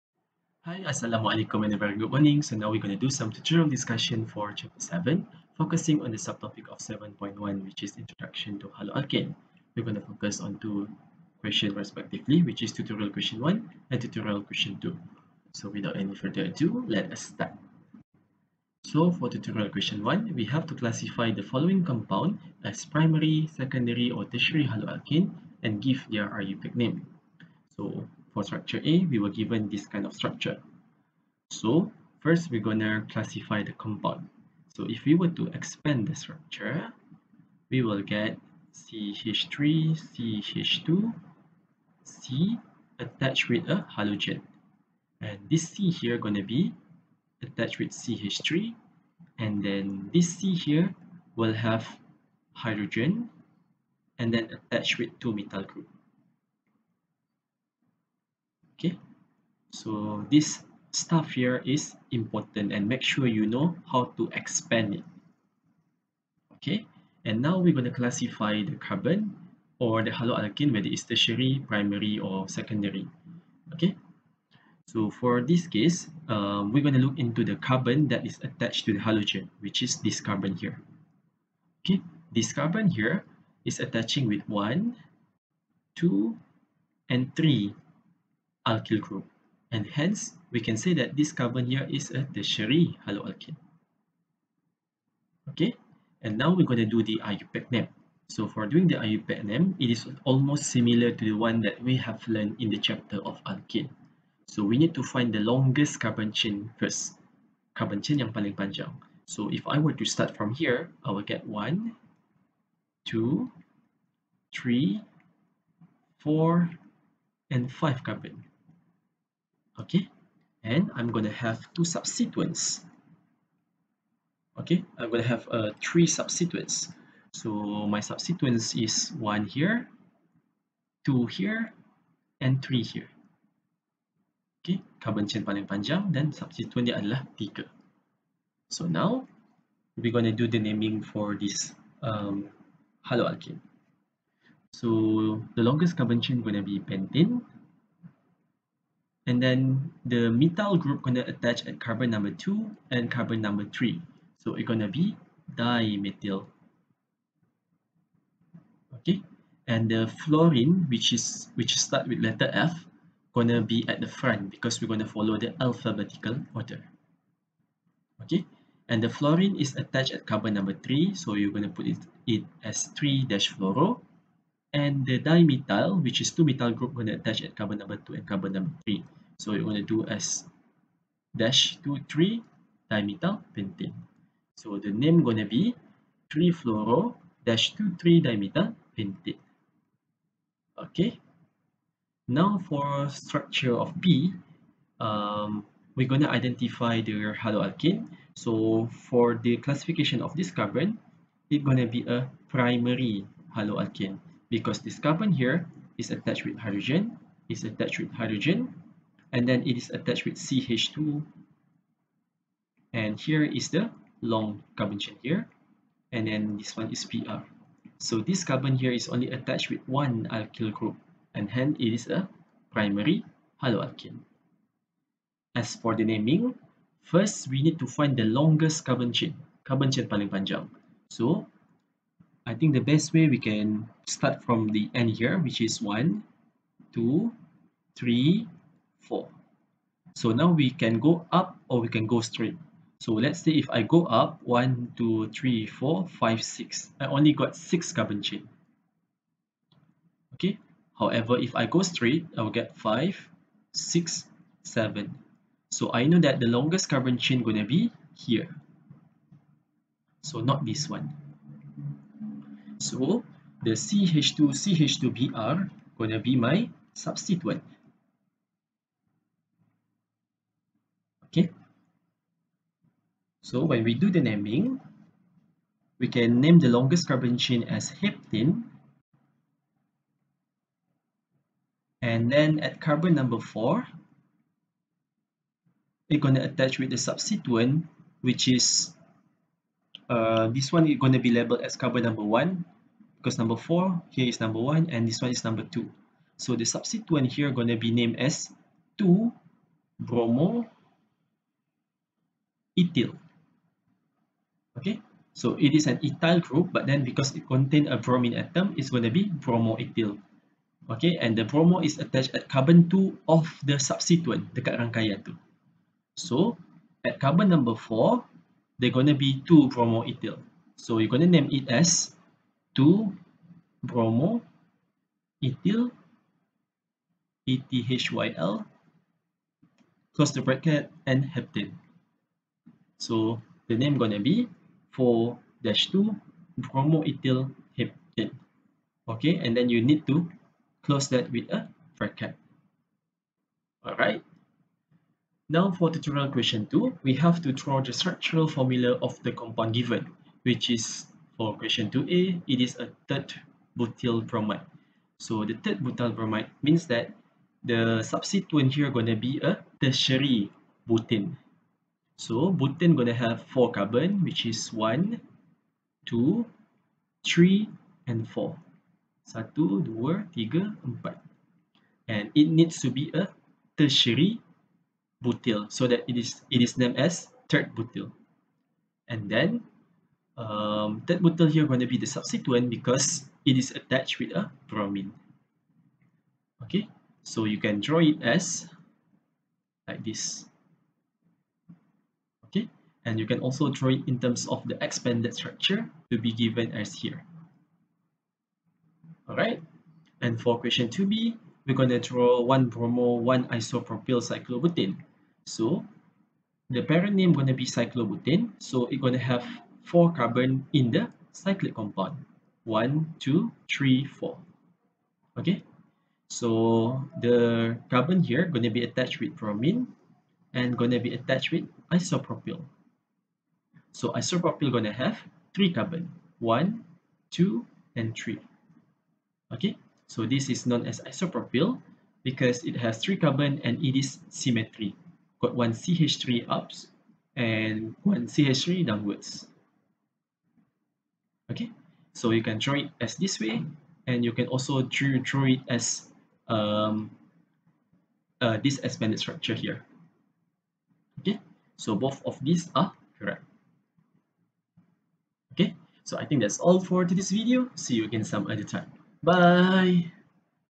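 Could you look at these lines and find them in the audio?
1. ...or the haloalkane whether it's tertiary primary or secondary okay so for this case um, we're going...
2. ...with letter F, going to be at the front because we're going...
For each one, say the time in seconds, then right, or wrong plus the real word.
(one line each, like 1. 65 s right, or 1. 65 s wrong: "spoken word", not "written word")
1. 69 s right
2. 162 s right.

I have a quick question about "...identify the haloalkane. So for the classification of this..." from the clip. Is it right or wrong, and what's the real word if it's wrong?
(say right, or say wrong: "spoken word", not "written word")
right.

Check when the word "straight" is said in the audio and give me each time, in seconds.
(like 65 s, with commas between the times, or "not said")
242 s, 251 s.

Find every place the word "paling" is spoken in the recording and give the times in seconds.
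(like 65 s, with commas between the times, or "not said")
108 s, 135 s, 230 s.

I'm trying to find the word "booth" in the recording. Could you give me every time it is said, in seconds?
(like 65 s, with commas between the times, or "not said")
not said.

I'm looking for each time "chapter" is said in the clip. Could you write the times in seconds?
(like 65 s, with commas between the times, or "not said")
4 s, 102 s.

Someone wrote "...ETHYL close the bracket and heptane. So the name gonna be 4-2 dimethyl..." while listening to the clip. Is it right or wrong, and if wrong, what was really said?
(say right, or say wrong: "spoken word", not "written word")
wrong: "bromoethyl", not "dimethyl".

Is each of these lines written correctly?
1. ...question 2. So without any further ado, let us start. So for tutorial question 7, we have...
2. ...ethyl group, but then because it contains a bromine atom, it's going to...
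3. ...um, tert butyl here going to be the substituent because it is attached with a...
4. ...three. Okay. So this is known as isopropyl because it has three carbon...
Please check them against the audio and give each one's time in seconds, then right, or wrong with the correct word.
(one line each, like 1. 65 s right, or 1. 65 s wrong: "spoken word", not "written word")
1. 14 s wrong: "1", not "7"
2. 306 s right
3. 380 s right
4. 428 s right.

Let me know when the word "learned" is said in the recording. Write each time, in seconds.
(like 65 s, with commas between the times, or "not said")
102 s.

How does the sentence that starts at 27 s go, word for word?
So for structure A, we were given this kind of structure.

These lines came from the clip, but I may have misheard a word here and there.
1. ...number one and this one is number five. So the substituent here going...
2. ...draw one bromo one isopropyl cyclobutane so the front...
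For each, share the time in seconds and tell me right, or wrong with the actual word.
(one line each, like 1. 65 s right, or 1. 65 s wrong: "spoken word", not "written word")
1. 294 s wrong: "two", not "five"
2. 402 s wrong: "parent", not "front".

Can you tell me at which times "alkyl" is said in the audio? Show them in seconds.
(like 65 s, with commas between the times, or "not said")
88 s, 220 s.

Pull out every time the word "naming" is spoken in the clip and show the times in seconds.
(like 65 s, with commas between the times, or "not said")
140 s, 226 s, 274 s.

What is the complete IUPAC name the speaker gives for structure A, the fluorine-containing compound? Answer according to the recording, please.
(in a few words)
3-fluoro-2,3-dimethylpentane.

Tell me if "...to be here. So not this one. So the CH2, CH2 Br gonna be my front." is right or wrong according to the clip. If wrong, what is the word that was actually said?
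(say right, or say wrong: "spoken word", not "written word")
wrong: "substituent", not "front".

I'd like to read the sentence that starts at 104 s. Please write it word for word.
So we need to find the longest carbon chain first.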